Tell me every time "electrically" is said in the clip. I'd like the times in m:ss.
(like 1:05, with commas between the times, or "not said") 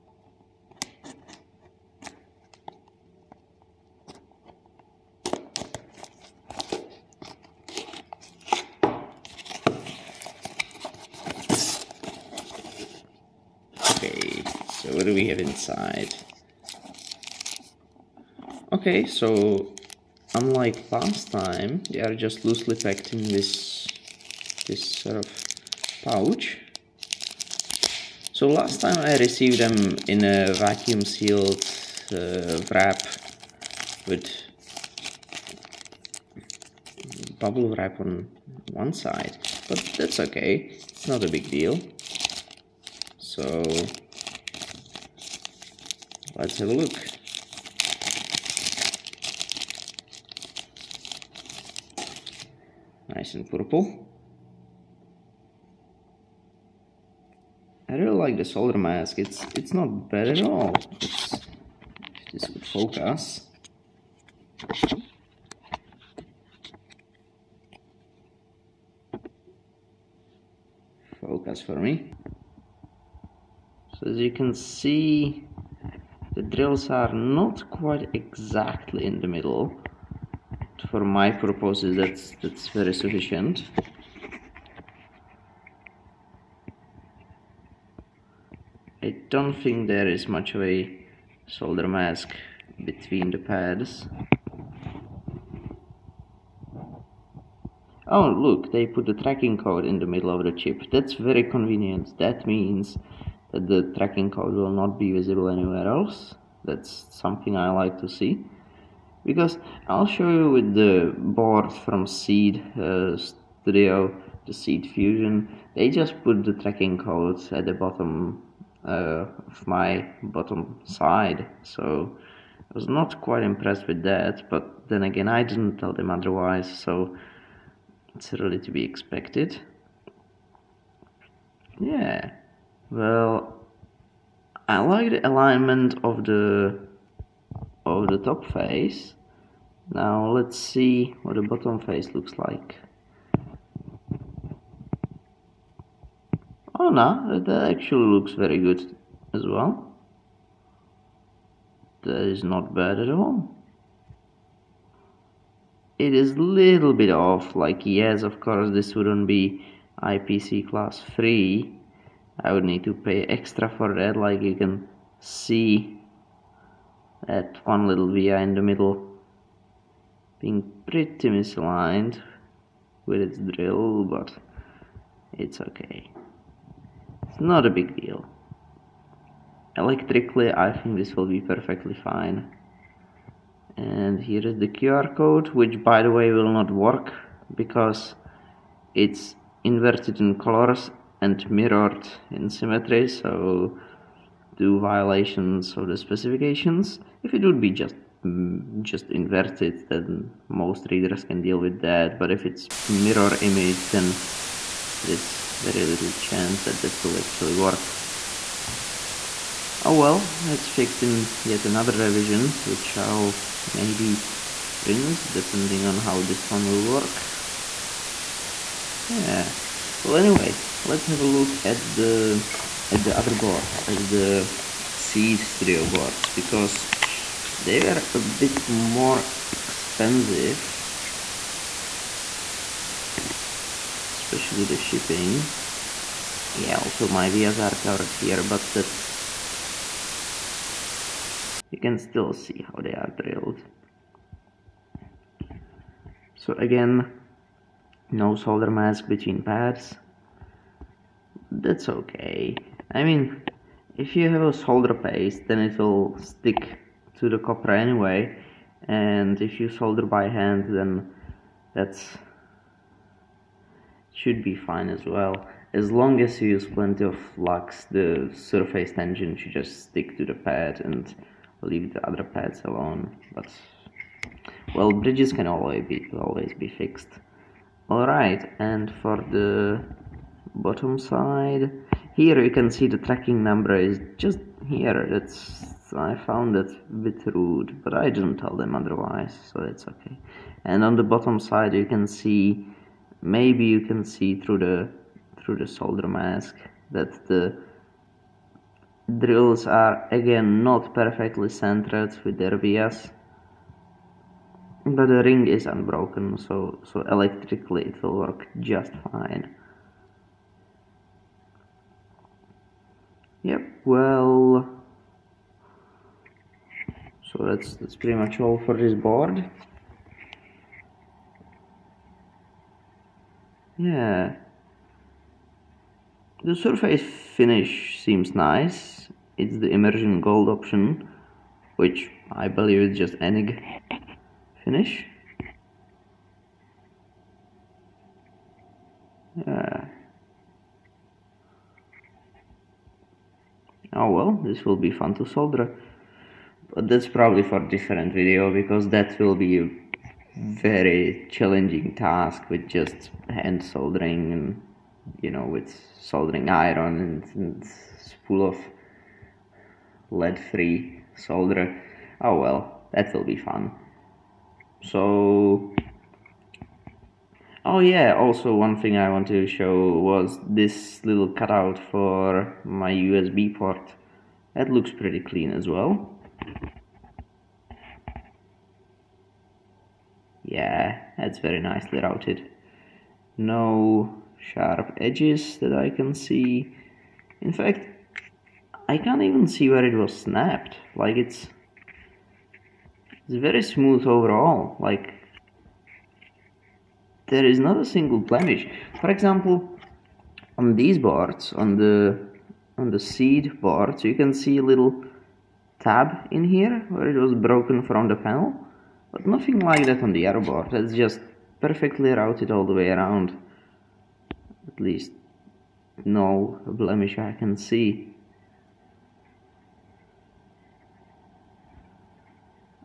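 2:59, 5:07.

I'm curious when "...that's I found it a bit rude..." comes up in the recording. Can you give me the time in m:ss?
4:45.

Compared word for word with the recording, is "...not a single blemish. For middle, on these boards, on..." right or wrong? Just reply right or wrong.
wrong.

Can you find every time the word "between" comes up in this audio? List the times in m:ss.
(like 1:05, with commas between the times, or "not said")
1:32, 4:09.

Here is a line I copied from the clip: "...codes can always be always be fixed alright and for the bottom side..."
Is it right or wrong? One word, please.
wrong.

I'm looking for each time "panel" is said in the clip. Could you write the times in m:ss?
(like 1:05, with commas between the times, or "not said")
6:48.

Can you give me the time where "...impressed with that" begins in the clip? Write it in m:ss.
2:03.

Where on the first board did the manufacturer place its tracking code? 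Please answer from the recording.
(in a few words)
In the middle of the chip.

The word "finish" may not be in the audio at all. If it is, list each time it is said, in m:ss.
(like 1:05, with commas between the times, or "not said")
5:27, 5:34.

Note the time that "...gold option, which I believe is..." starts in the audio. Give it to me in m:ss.
5:30.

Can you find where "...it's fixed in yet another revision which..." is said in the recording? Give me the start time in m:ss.
3:30.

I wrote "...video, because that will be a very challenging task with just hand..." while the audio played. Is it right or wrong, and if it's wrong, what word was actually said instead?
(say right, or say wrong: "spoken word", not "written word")
right.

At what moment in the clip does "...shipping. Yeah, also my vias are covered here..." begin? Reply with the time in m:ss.
3:54.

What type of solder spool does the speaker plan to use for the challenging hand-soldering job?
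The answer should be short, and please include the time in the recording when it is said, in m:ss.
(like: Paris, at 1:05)
Lead-free, at 6:00.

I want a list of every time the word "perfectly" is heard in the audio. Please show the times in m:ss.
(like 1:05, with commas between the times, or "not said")
3:01, 5:00, 6:51.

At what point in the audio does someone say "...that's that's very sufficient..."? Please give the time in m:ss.
1:21.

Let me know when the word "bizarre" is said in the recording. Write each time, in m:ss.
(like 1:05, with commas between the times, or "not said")
not said.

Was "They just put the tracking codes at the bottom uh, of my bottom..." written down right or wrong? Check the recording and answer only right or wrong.
right.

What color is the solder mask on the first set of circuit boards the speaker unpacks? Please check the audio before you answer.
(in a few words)
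Purple.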